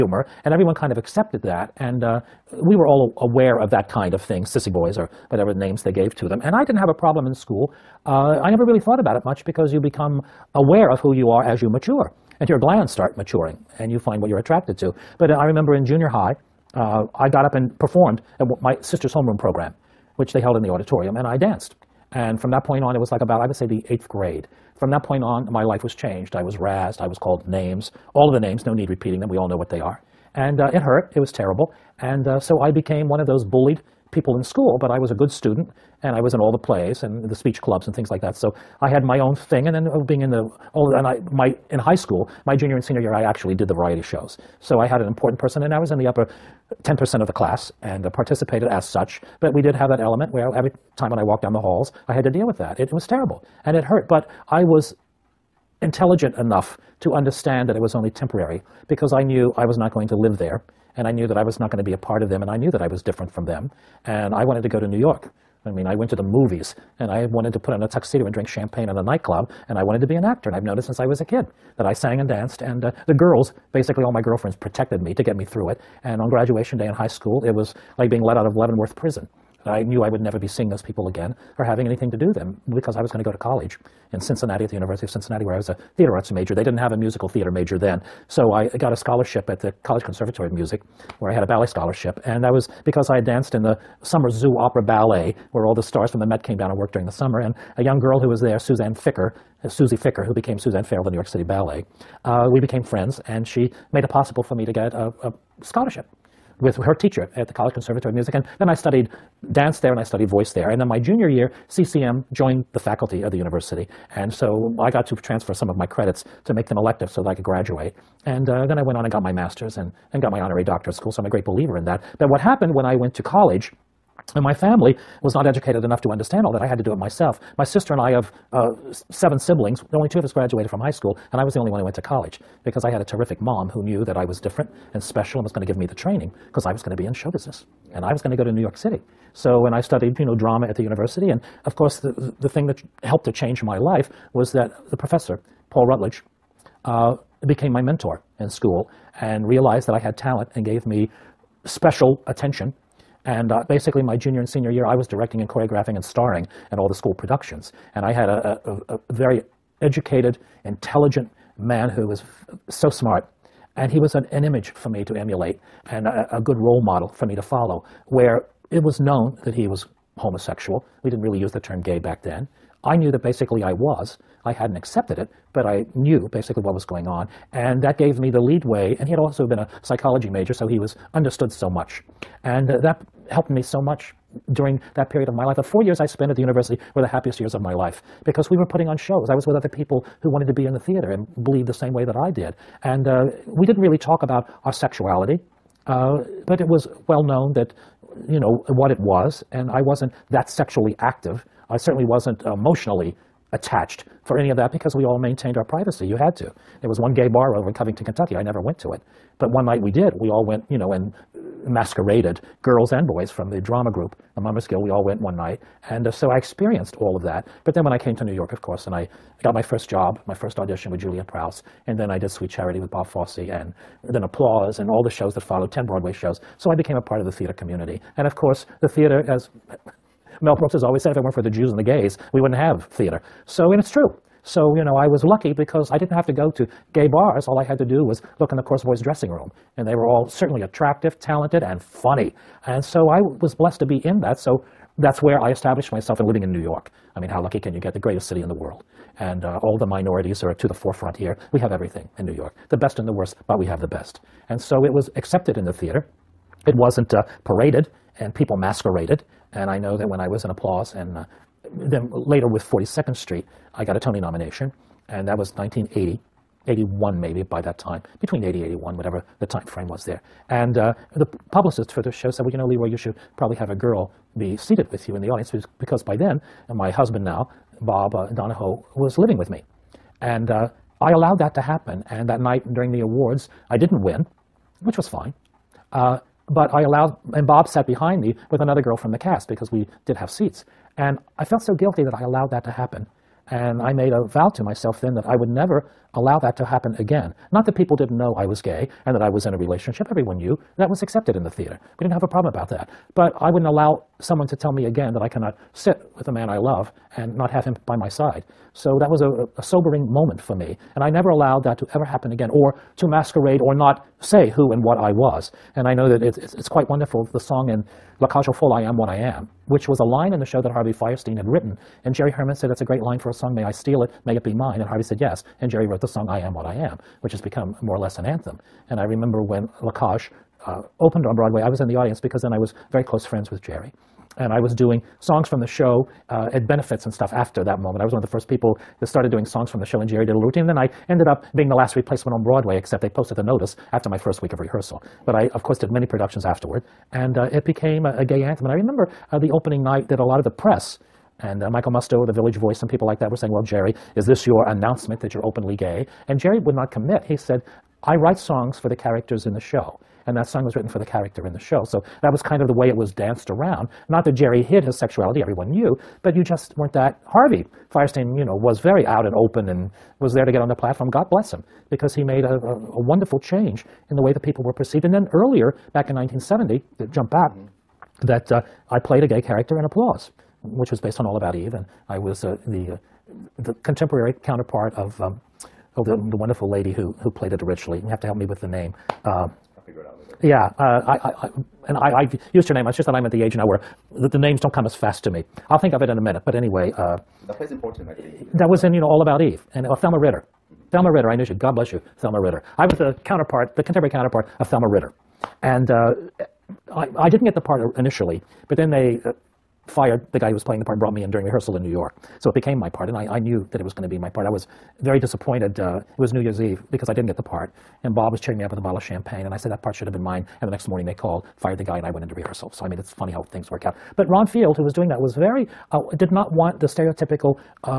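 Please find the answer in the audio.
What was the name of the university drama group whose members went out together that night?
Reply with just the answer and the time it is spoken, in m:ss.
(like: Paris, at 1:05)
Mummers Guild, at 3:34.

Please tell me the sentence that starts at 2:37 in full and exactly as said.
And I had a, a, a very educated, intelligent man who was so smart.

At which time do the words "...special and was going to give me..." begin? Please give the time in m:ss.
2:15.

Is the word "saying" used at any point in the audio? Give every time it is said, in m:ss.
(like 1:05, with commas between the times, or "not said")
5:53.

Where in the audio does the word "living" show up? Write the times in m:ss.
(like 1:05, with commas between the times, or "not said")
4:06, 4:39.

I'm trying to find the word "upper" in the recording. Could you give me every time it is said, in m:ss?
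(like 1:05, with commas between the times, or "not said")
0:46.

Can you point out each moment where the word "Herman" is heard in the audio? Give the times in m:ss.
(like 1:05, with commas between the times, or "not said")
5:22.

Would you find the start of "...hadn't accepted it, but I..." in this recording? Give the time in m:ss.
2:54.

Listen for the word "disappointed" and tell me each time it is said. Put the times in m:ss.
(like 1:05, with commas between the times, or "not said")
6:55.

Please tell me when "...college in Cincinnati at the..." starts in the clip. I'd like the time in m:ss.
1:23.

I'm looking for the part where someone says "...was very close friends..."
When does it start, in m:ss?
5:32.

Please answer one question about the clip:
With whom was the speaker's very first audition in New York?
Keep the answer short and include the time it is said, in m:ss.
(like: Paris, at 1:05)
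Juliet Prowse, at 3:40.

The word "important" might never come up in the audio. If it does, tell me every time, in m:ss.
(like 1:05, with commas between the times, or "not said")
0:45, 6:37.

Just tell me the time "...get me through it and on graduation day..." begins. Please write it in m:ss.
1:15.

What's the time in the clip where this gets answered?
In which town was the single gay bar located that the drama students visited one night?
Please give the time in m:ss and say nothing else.
3:27.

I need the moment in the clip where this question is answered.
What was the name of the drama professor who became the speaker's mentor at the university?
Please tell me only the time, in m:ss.
2:25.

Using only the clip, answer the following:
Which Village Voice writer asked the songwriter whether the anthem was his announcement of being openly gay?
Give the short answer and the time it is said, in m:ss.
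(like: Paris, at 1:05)
Michael Musto, at 5:51.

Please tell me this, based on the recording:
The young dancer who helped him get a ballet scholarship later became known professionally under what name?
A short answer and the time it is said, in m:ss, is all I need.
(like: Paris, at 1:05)
Suzanne Farrell, at 1:40.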